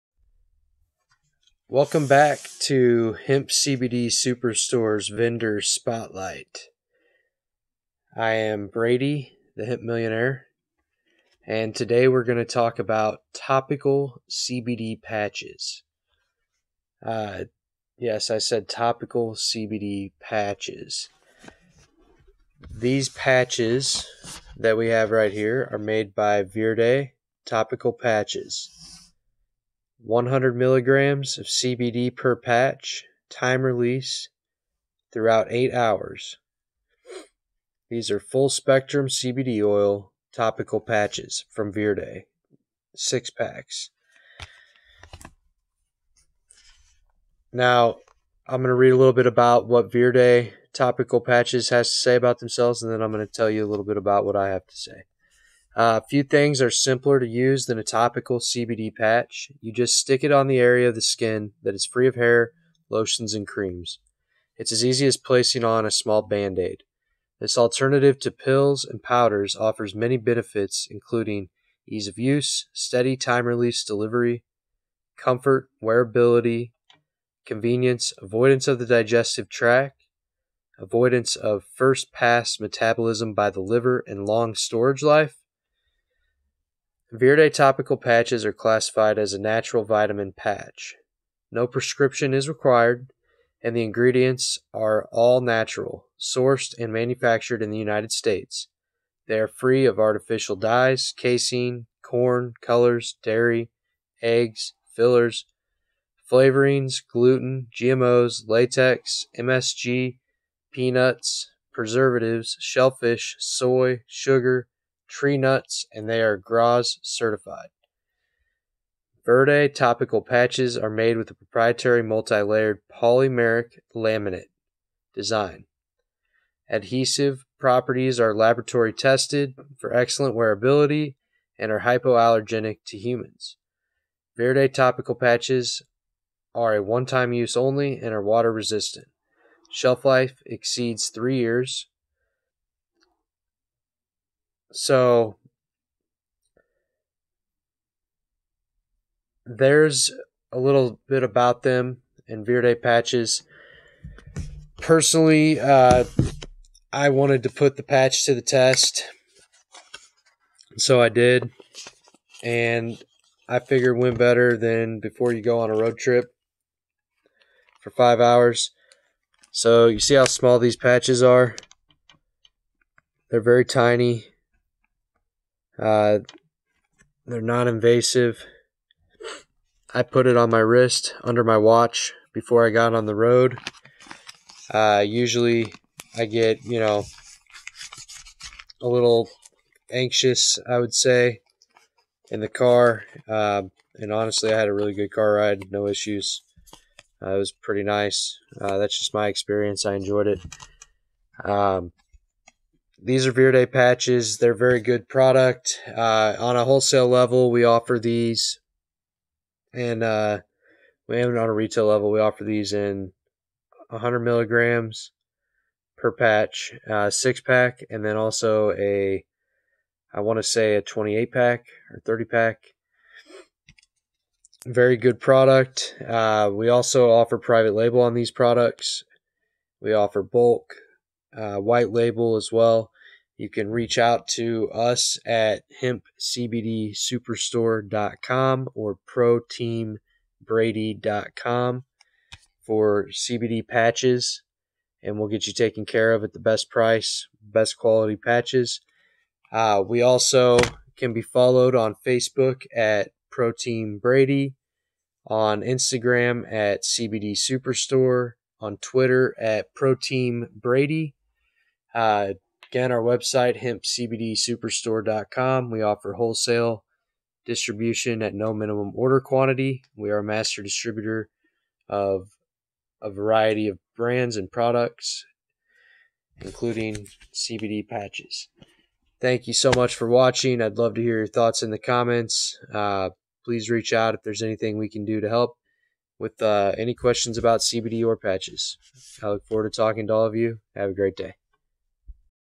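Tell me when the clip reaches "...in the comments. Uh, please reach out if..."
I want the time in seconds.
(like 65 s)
281 s.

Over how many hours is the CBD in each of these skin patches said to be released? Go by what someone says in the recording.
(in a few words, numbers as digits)
8 hours.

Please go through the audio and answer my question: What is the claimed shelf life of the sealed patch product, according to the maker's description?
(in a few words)
over 3 years.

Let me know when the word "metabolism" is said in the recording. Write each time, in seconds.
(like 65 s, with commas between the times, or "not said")
82 s.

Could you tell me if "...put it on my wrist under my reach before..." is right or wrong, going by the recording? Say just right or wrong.
wrong.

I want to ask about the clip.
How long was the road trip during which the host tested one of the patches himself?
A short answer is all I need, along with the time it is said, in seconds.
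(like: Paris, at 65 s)
5 hours, at 167 s.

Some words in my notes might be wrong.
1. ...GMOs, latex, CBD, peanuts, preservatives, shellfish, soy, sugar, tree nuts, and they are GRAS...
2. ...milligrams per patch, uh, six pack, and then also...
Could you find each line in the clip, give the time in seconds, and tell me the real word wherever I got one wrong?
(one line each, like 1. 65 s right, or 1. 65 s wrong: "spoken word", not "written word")
1. 107 s wrong: "MSG", not "CBD"
2. 214 s right.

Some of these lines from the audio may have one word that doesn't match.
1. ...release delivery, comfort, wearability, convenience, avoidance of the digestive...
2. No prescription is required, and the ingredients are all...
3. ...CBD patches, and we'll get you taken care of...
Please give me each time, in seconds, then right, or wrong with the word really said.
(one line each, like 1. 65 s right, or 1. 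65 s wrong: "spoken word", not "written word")
1. 73 s right
2. 91 s right
3. 243 s right.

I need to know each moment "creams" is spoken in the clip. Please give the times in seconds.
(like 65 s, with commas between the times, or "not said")
63 s.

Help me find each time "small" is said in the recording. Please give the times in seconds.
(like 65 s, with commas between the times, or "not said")
65 s, 170 s.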